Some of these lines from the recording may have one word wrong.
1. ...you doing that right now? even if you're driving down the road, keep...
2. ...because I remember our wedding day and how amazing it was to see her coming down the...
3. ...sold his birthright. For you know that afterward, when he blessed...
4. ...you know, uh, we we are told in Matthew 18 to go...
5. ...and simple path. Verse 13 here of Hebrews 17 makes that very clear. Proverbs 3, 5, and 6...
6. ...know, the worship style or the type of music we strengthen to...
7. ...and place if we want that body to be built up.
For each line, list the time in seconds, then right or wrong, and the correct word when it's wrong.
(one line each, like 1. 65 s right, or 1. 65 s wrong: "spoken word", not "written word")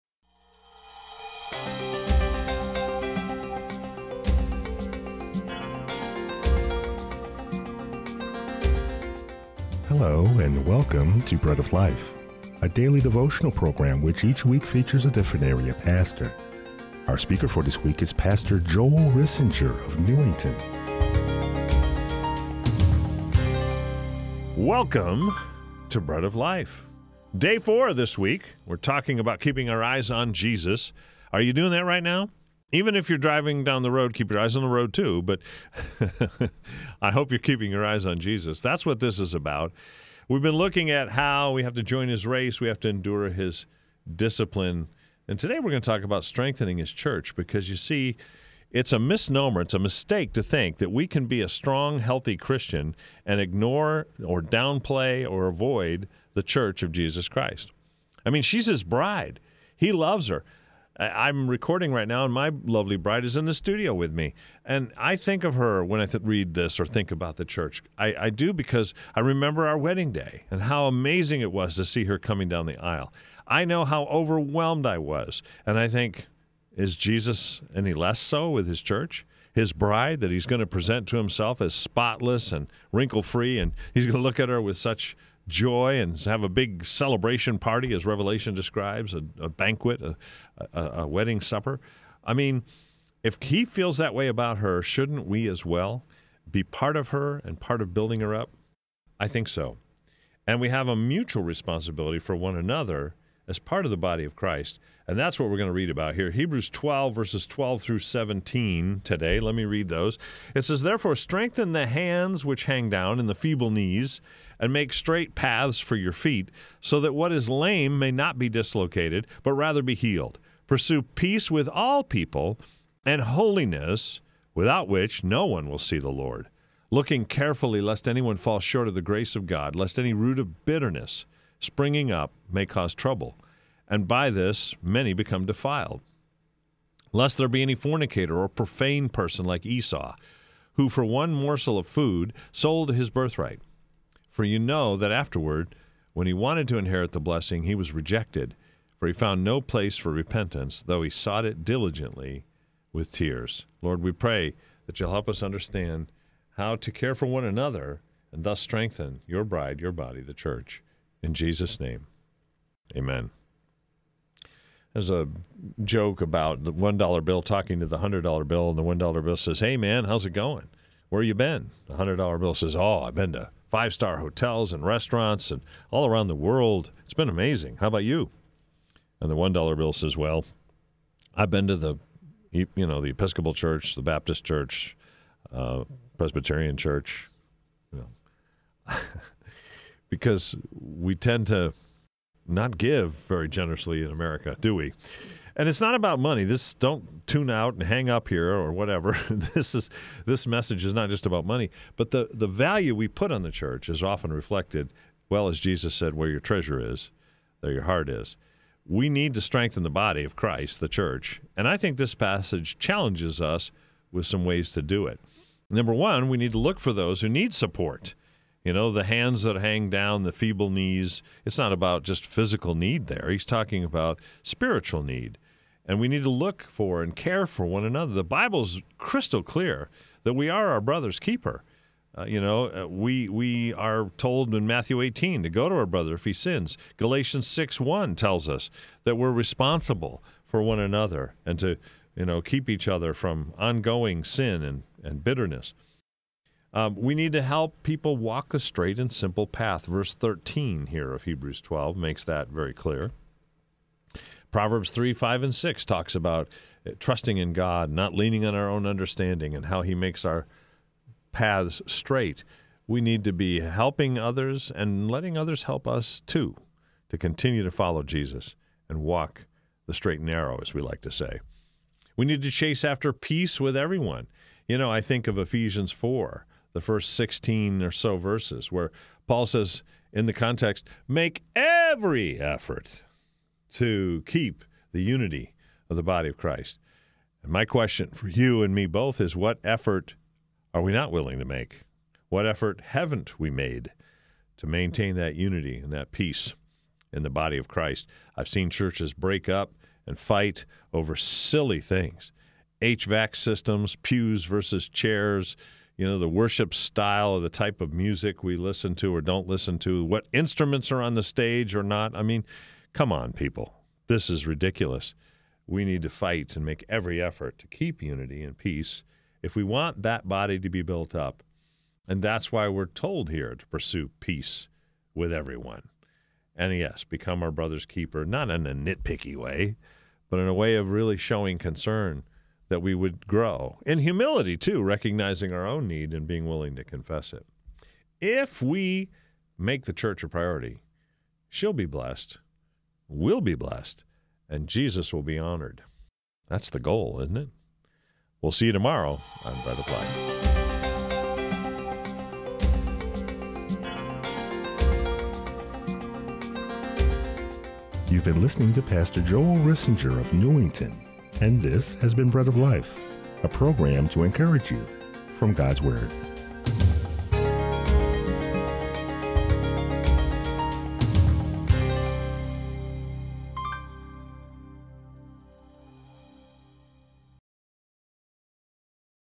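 1. 31 s right
2. 68 s right
3. 142 s wrong: "wanted", not "blessed"
4. 232 s right
5. 248 s wrong: "12", not "17"
6. 306 s wrong: "listen", not "strengthen"
7. 318 s wrong: "peace", not "place".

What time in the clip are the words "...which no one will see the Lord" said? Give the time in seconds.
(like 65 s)
124 s.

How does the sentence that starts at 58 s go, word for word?
I mean, she's his bride, he loves her.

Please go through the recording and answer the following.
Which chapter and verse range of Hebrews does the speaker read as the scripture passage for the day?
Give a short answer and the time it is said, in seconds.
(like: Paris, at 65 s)
Hebrews 12:12-17, at 106 s.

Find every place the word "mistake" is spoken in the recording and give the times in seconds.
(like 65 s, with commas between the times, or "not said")
49 s.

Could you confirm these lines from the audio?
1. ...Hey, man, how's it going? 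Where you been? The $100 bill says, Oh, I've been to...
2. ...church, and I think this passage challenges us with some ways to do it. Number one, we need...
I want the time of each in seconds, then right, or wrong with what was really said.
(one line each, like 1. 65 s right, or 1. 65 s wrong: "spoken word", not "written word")
1. 169 s right
2. 210 s right.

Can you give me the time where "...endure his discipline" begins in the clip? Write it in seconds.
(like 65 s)
42 s.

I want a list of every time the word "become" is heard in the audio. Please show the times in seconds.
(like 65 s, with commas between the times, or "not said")
135 s, 327 s.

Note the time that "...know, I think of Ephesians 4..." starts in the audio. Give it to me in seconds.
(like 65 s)
274 s.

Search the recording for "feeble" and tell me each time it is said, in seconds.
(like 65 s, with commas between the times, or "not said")
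113 s, 220 s.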